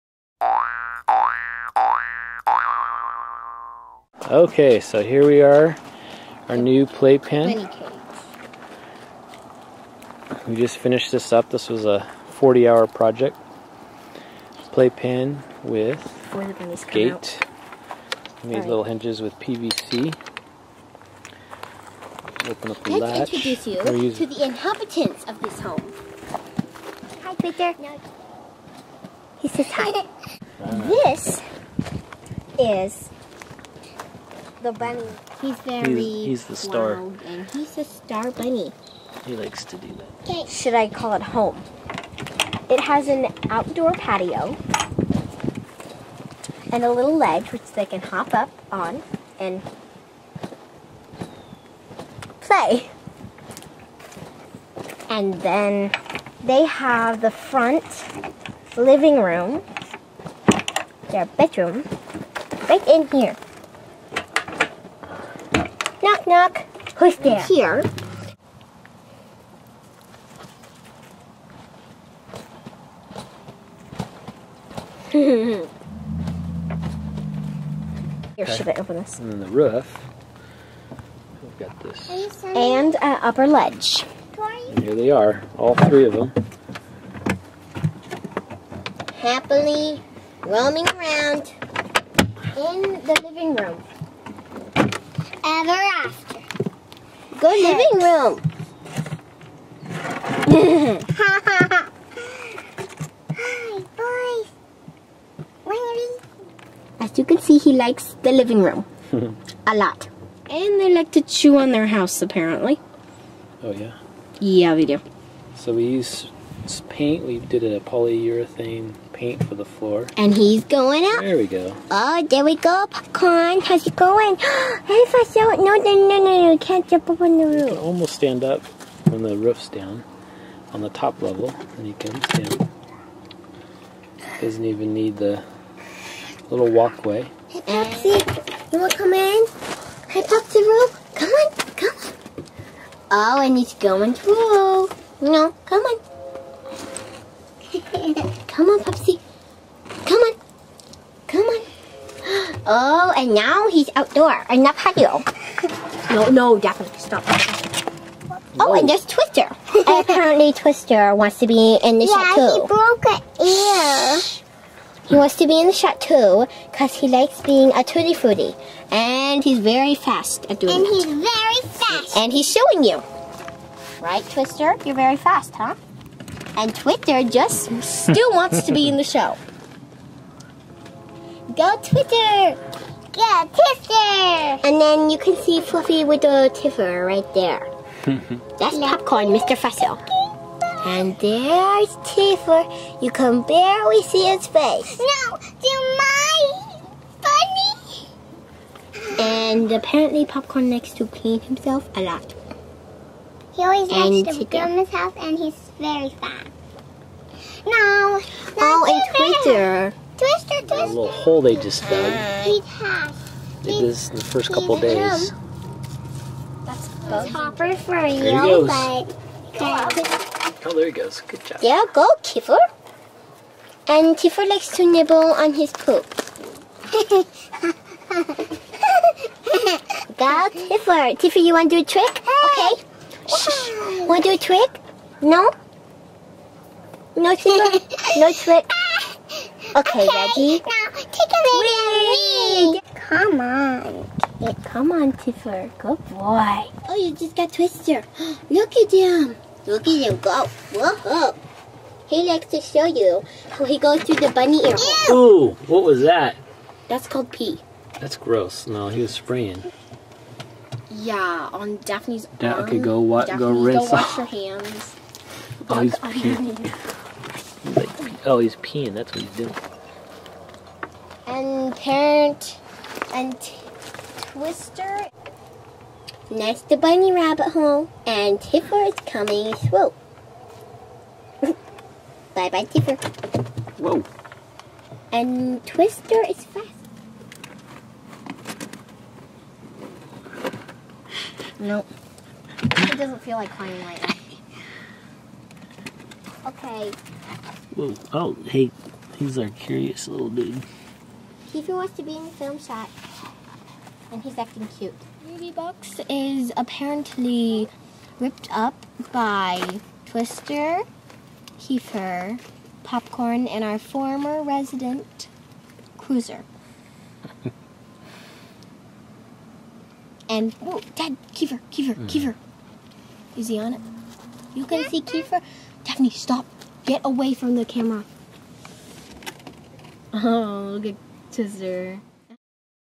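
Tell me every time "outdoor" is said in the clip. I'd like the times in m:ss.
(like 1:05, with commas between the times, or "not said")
0:43, 2:33.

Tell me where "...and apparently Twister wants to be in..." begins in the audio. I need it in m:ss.
2:39.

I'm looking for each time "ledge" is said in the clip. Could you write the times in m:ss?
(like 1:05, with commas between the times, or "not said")
0:47, 1:23.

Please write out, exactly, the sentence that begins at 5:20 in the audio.
and, whoa, Dad, Kiefer, Kiefer, mm.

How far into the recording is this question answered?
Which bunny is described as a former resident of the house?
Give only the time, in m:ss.
5:15.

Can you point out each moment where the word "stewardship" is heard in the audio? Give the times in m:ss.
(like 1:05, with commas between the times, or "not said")
not said.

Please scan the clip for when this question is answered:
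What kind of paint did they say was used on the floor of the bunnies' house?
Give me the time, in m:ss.
1:57.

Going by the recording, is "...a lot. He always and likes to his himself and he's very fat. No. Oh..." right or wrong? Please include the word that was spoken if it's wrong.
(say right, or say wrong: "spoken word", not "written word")
right.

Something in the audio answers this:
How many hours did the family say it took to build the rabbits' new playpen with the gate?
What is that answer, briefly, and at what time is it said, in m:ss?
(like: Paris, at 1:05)
40 hours, at 0:12.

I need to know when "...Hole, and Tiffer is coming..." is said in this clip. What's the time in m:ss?
4:37.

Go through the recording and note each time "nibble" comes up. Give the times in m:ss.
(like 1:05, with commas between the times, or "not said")
3:44.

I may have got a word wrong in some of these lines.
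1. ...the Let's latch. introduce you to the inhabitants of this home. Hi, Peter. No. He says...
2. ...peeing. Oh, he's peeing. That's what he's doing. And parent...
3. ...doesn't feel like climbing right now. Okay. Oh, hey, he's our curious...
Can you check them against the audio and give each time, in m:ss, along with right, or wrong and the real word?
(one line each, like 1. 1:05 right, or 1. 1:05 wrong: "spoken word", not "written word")
1. 0:22 right
2. 4:25 right
3. 4:52 right.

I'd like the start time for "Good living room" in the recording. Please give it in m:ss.
1:37.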